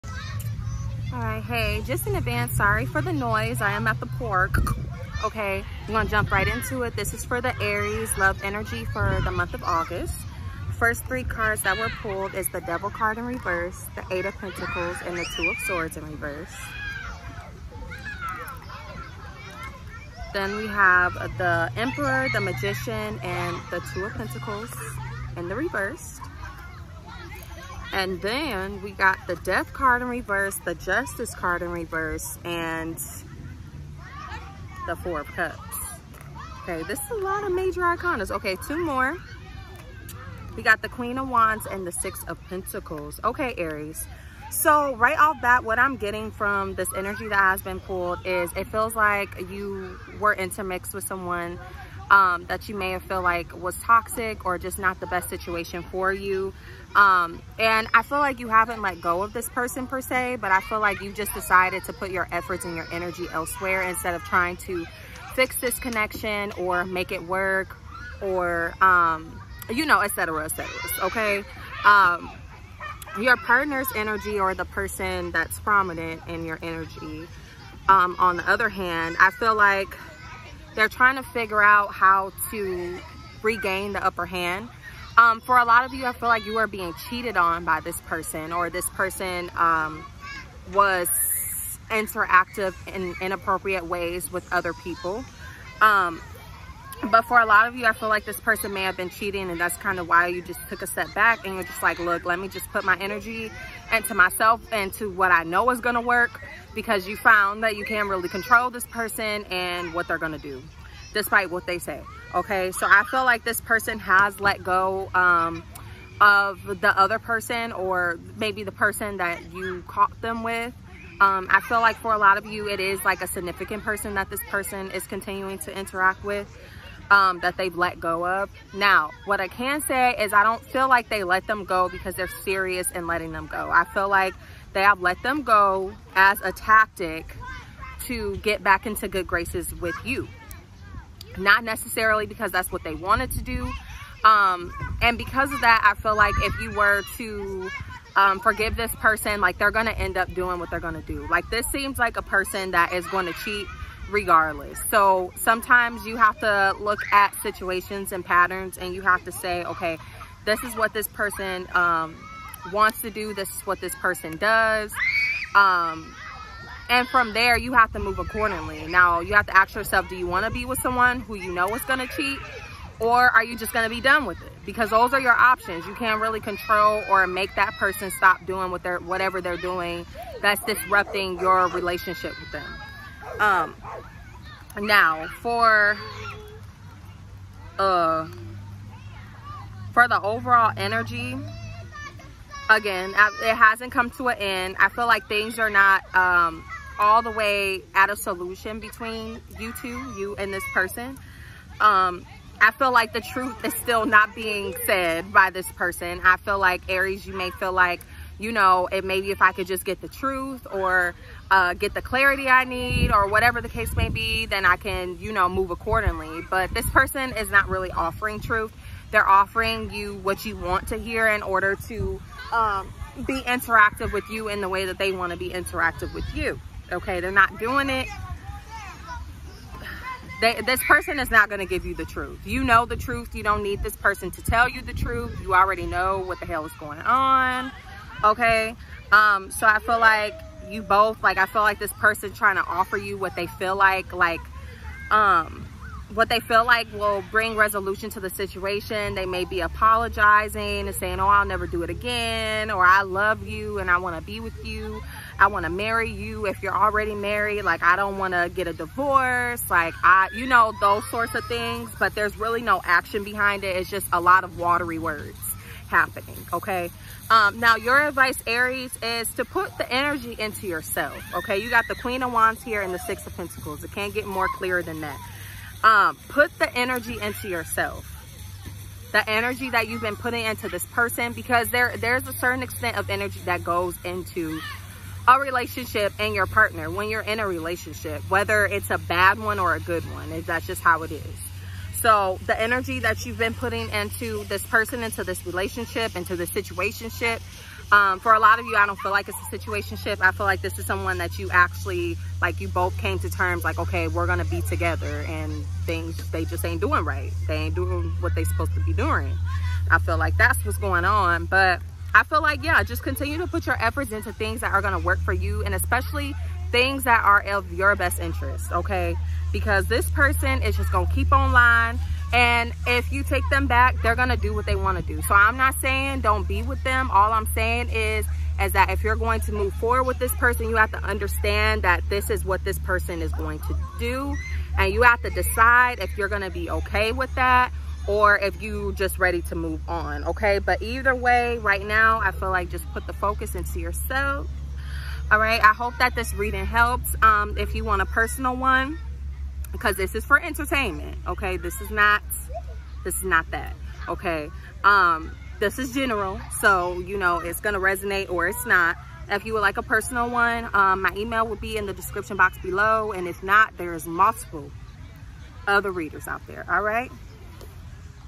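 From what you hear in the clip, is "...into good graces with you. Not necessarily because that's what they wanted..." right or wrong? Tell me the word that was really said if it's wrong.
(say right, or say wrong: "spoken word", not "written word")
right.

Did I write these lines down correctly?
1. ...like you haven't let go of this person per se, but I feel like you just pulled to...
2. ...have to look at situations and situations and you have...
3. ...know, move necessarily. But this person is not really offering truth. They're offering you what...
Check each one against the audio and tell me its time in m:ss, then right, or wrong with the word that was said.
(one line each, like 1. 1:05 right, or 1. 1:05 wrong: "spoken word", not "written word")
1. 0:58 wrong: "decided", not "pulled"
2. 2:36 wrong: "patterns", not "situations"
3. 3:35 wrong: "accordingly", not "necessarily".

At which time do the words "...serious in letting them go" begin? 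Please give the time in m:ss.
2:12.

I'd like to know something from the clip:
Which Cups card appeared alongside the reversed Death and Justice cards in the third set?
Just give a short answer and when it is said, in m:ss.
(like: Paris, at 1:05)
Four of Cups, at 0:34.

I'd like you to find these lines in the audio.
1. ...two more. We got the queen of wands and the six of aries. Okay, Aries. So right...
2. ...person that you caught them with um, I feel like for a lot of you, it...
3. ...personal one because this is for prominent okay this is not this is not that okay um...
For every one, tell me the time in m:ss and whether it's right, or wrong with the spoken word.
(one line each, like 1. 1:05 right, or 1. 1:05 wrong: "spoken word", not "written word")
1. 0:38 wrong: "pentacles", not "aries"
2. 1:58 right
3. 5:48 wrong: "entertainment", not "prominent".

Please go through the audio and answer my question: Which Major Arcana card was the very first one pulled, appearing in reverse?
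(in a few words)
The Devil.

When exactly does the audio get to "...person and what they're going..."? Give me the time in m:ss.
1:48.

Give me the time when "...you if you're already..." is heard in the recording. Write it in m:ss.
4:16.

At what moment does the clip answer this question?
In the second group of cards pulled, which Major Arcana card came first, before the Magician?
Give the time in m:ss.
0:21.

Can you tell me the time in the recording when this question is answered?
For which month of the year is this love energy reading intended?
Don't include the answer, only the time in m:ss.
0:09.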